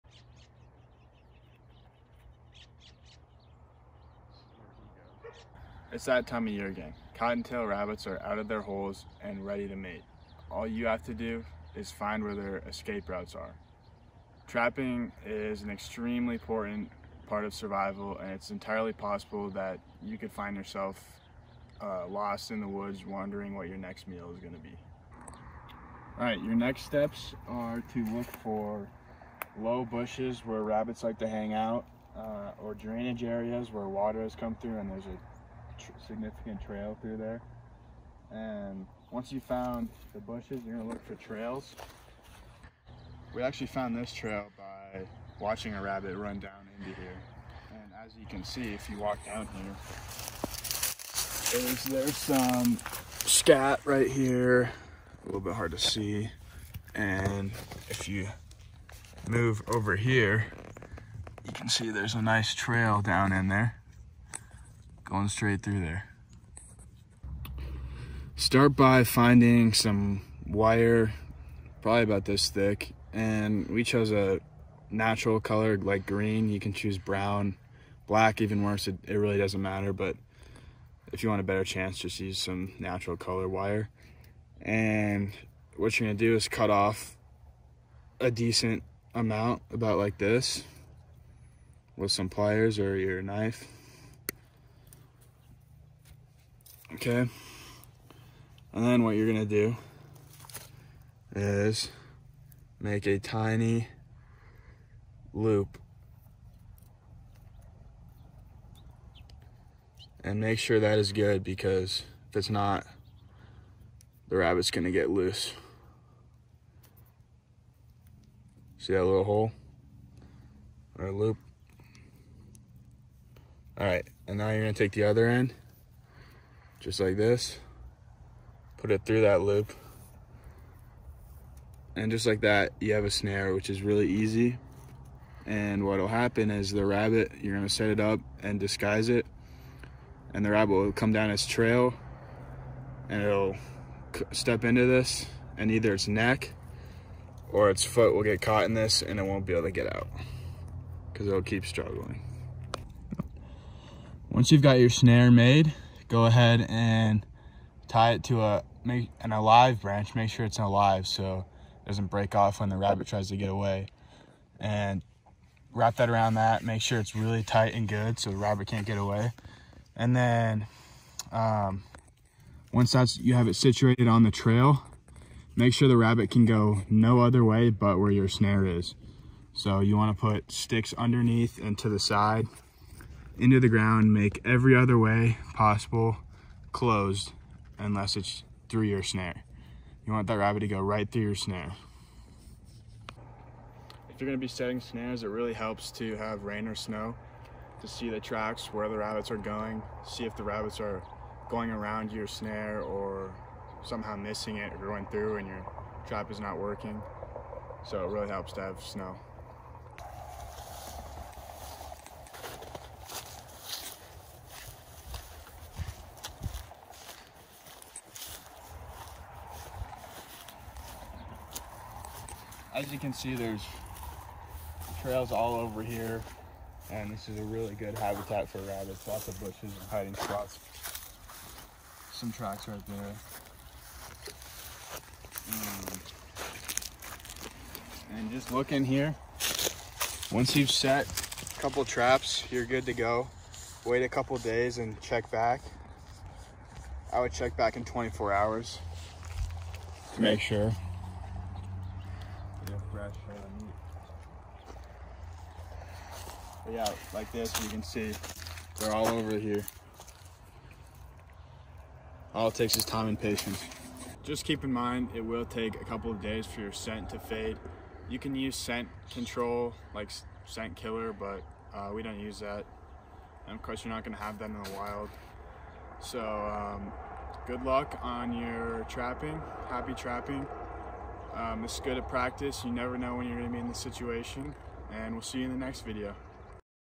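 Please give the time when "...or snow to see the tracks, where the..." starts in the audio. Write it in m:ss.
3:16.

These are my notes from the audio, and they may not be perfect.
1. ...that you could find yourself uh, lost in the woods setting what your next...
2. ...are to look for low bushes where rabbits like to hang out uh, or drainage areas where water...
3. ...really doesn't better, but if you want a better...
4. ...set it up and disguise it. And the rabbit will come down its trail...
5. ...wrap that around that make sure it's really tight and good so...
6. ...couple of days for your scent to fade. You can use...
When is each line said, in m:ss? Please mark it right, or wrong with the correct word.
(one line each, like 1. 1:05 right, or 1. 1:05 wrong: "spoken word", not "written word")
1. 0:19 wrong: "wondering", not "setting"
2. 0:27 right
3. 1:19 wrong: "matter", not "better"
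4. 2:17 right
5. 2:45 right
6. 4:25 right.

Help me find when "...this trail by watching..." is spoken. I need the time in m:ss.
0:43.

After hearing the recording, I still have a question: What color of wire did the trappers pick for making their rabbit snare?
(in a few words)
green.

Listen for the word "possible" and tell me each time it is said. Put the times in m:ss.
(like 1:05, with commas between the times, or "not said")
0:18, 3:05.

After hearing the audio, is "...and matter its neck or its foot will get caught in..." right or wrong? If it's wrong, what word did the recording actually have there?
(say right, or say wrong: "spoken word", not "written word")
wrong: "either", not "matter".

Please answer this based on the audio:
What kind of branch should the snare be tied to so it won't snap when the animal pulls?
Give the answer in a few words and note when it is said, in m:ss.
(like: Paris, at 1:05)
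an alive branch, at 2:39.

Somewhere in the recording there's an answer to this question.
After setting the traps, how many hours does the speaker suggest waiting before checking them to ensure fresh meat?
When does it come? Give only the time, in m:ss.
4:07.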